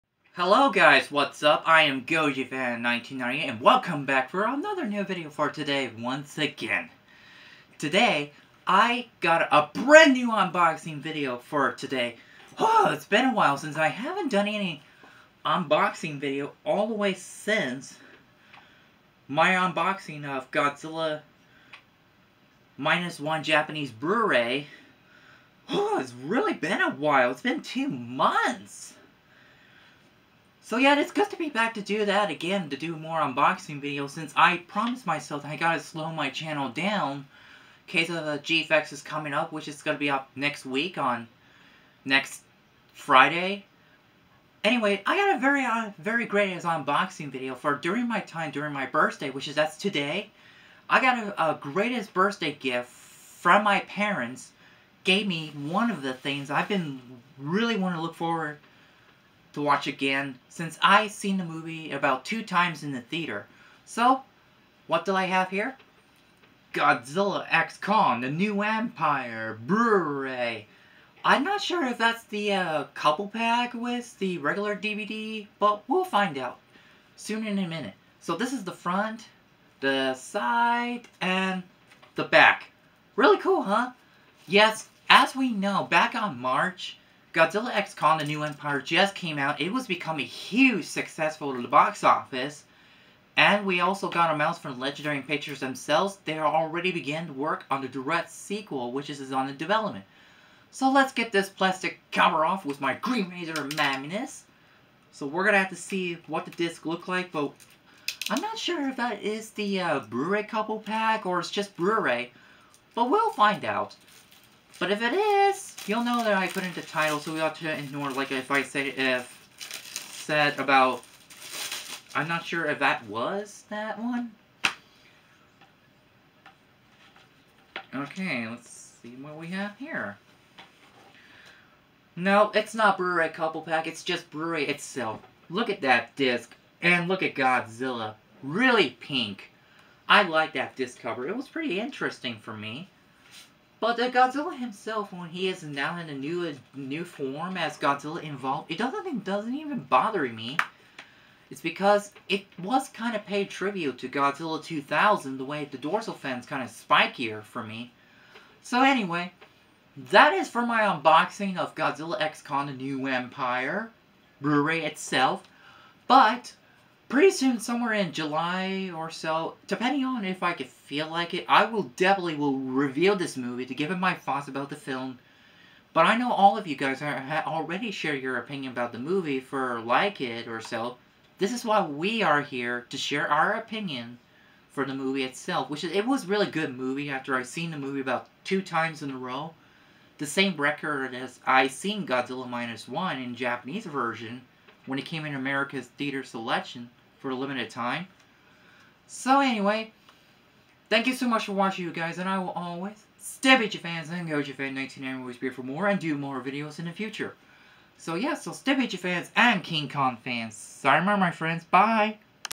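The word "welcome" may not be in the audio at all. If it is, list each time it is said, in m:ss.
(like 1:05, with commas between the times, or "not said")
0:03.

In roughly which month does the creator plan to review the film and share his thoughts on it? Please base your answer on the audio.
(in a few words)
July.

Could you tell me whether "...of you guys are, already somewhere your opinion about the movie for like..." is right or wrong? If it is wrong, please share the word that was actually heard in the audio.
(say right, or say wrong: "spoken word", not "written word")
wrong: "share", not "somewhere".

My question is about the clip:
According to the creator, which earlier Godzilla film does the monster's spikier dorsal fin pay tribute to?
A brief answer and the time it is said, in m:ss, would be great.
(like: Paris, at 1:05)
Godzilla 2000, at 2:34.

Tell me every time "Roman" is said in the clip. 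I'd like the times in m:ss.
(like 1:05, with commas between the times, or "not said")
not said.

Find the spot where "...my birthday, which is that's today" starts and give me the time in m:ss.
0:48.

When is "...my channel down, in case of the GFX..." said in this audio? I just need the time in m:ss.
0:36.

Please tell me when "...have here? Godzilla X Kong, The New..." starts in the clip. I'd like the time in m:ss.
1:05.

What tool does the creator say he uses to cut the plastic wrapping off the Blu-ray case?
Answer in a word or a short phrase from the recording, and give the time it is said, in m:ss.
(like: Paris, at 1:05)
Green Razor Magnus, at 1:42.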